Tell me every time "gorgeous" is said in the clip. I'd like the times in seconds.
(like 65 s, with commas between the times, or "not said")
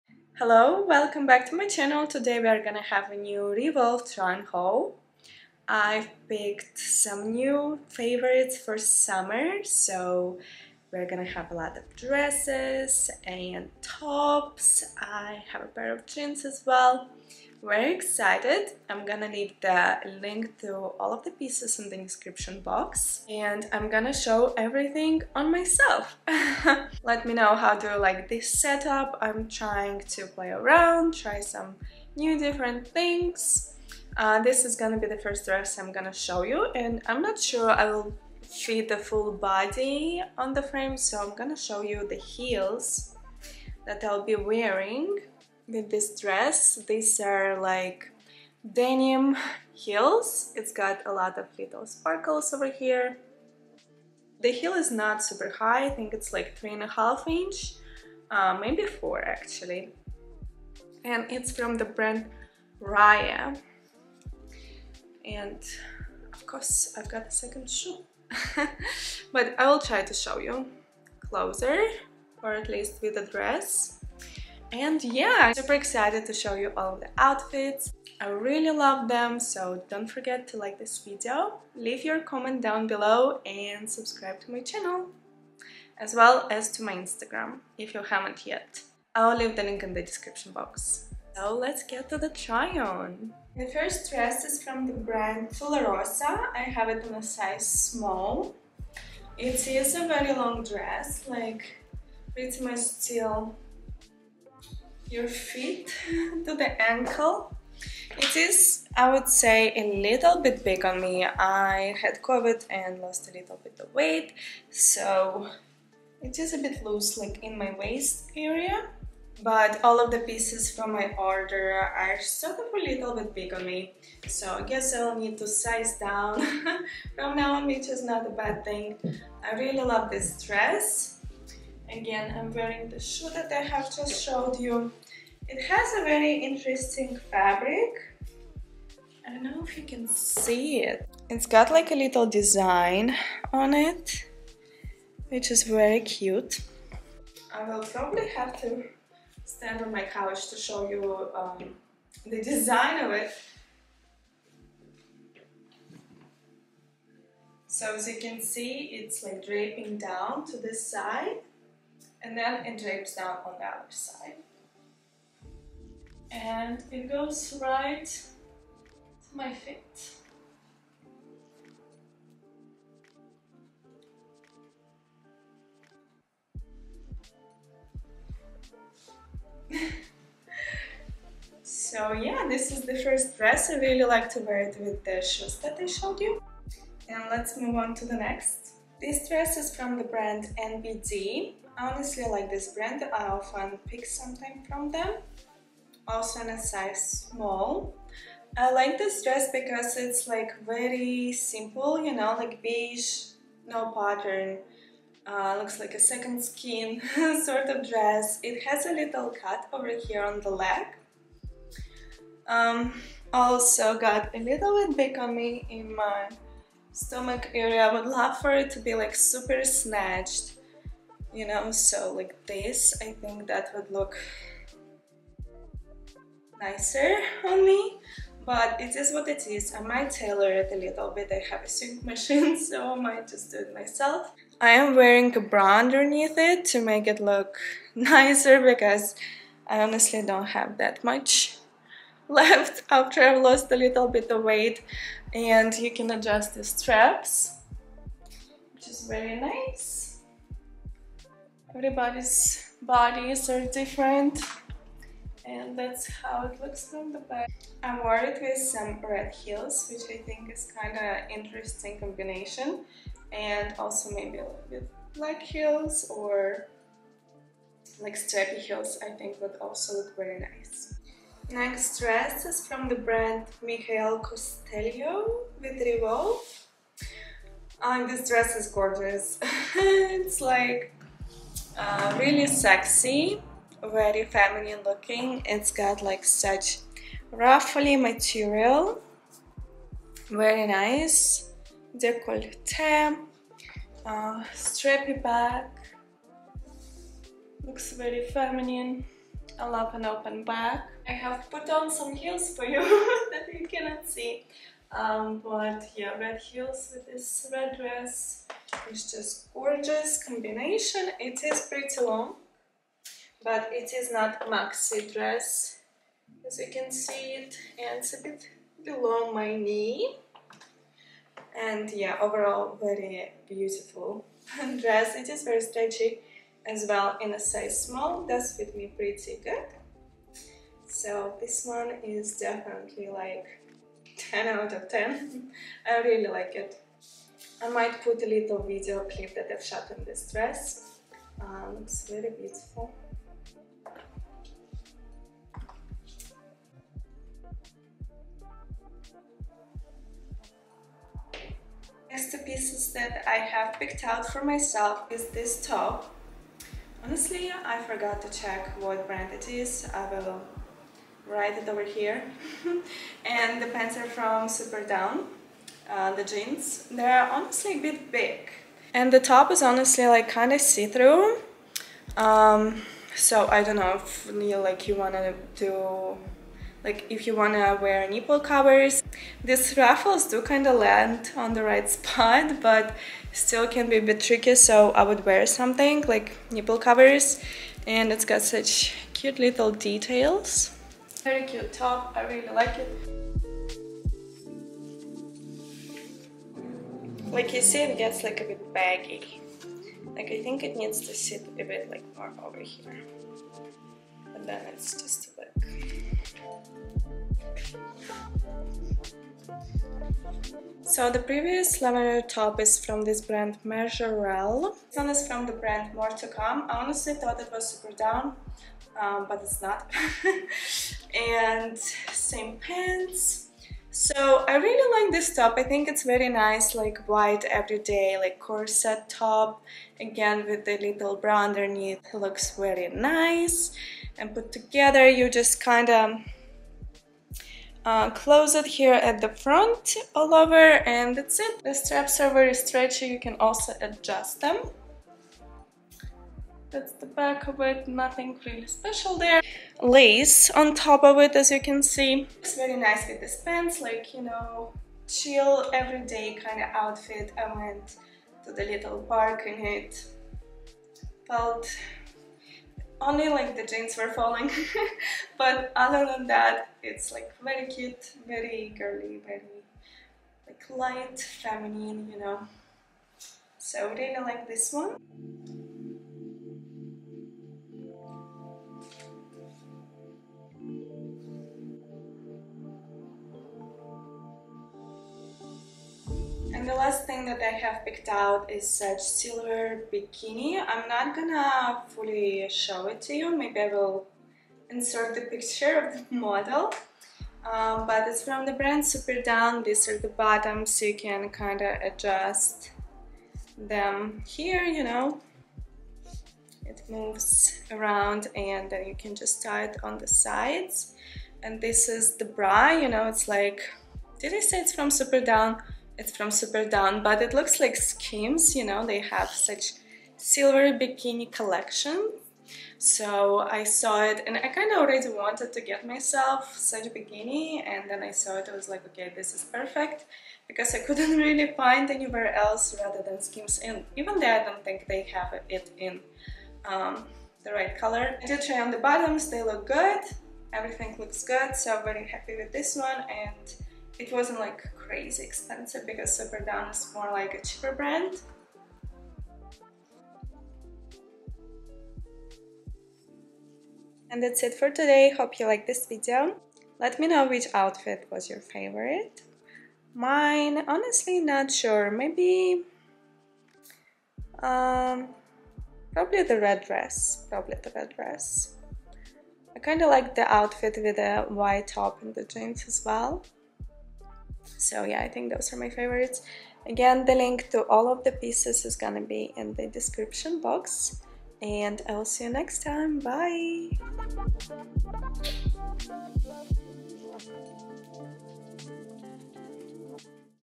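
278 s, 309 s.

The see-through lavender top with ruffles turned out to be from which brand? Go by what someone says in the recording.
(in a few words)
Majorelle.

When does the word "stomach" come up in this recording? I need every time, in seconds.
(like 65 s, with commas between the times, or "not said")
216 s.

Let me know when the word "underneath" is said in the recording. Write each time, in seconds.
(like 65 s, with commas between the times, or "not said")
235 s, 431 s.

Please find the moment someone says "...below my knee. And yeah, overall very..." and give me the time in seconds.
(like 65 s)
318 s.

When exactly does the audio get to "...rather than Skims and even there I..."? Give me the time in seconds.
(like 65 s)
532 s.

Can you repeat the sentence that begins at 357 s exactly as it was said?
Honestly, I forgot to check what brand it is.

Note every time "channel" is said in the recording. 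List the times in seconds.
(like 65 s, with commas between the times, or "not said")
1 s, 84 s.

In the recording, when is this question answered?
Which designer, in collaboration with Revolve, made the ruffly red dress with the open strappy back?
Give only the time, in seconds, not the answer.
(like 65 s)
273 s.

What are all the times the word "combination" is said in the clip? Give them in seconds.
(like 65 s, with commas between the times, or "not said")
261 s, 310 s.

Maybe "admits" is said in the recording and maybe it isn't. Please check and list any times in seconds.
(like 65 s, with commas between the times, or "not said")
not said.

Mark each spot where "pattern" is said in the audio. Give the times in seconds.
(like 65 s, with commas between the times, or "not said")
203 s.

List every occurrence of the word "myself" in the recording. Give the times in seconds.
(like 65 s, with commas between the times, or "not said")
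25 s, 233 s, 354 s, 525 s.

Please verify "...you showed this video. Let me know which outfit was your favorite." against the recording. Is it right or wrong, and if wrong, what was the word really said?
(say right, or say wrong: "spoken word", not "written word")
wrong: "liked", not "showed".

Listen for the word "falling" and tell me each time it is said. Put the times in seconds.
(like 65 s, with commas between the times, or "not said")
464 s.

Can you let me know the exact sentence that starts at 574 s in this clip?
So yeah, I think those are my favorites.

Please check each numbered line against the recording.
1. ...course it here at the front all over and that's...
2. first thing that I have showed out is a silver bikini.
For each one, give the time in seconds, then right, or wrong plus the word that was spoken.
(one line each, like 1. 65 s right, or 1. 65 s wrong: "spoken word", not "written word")
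1. 438 s wrong: "close", not "course"
2. 486 s wrong: "picked", not "showed".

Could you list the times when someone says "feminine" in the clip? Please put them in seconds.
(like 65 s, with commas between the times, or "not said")
284 s, 298 s, 471 s.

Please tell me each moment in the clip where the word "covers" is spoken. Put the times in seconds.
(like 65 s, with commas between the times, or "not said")
378 s, 386 s.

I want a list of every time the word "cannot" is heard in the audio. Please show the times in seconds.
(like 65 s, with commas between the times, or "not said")
303 s.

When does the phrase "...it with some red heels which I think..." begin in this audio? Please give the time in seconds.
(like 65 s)
258 s.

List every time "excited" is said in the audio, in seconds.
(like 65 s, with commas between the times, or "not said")
17 s, 75 s.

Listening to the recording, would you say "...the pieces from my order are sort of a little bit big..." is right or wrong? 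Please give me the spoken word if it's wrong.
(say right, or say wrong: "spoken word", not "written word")
right.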